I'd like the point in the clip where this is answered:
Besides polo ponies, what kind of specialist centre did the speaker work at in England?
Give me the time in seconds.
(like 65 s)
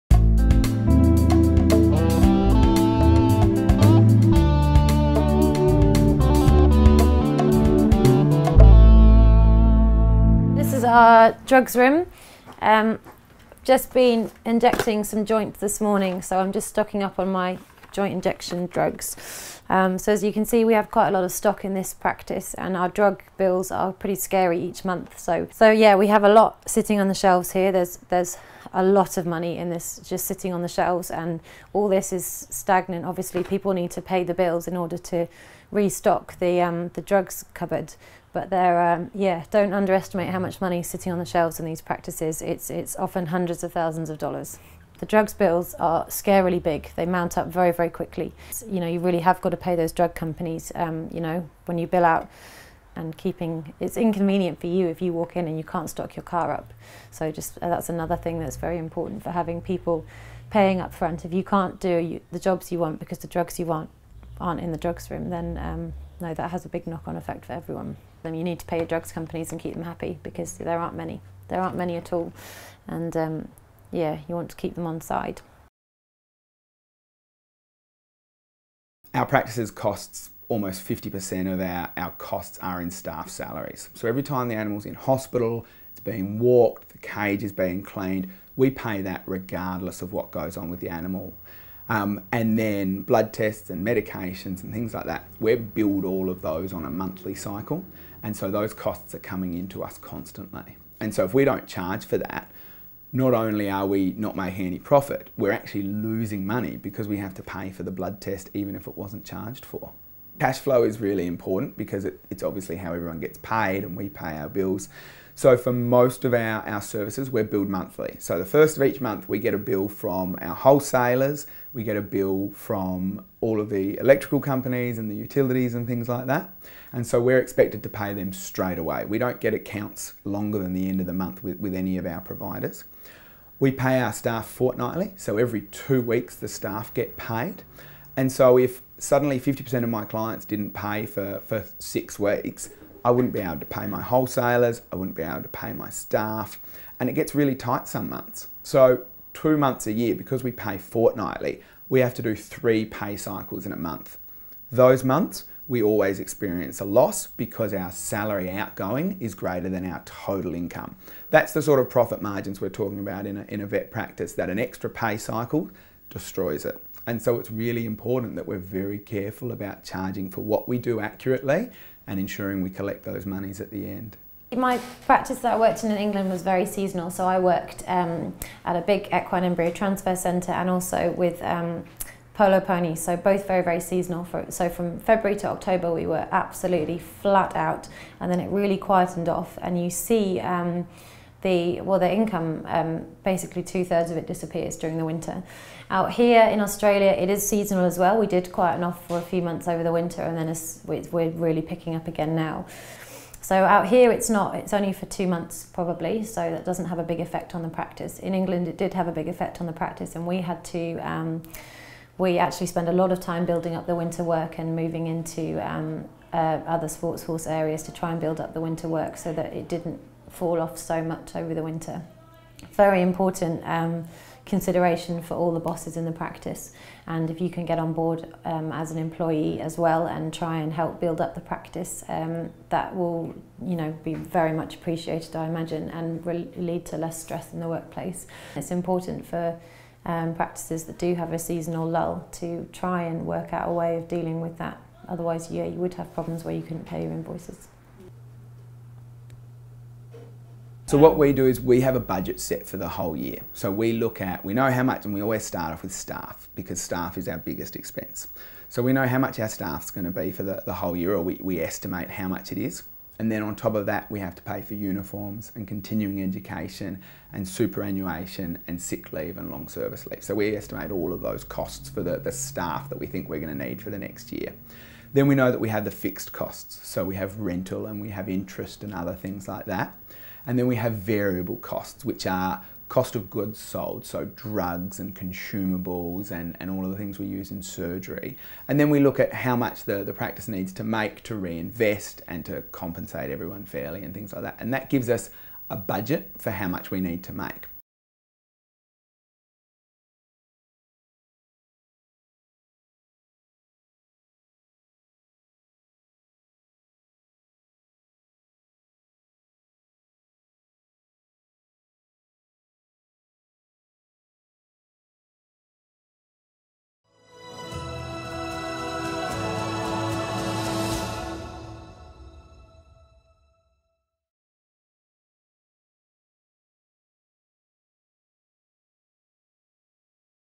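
179 s.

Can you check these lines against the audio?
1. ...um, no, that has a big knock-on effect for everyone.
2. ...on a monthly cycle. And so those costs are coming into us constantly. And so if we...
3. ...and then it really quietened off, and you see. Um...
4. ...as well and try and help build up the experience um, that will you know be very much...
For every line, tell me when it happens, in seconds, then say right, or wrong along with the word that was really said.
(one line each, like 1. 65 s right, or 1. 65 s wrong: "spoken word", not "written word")
1. 65 s right
2. 96 s right
3. 188 s right
4. 229 s wrong: "practice", not "experience".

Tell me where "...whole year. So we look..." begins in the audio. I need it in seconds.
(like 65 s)
252 s.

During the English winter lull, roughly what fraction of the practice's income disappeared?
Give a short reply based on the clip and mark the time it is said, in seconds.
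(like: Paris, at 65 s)
Two thirds, at 193 s.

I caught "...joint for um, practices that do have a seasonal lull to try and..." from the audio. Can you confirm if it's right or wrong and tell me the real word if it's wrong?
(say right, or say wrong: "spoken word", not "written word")
wrong: "important", not "joint".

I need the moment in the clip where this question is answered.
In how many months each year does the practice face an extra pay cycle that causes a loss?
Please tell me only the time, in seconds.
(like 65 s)
149 s.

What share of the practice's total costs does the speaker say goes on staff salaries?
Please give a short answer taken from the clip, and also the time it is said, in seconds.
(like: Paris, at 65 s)
almost 50%, at 80 s.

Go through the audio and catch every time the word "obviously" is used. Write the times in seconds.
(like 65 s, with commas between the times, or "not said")
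33 s, 112 s.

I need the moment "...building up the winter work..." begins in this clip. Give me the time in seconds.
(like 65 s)
213 s.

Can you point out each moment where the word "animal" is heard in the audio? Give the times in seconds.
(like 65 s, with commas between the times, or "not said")
84 s, 90 s.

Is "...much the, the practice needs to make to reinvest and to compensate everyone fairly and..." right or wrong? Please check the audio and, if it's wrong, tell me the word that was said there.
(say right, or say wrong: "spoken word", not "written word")
right.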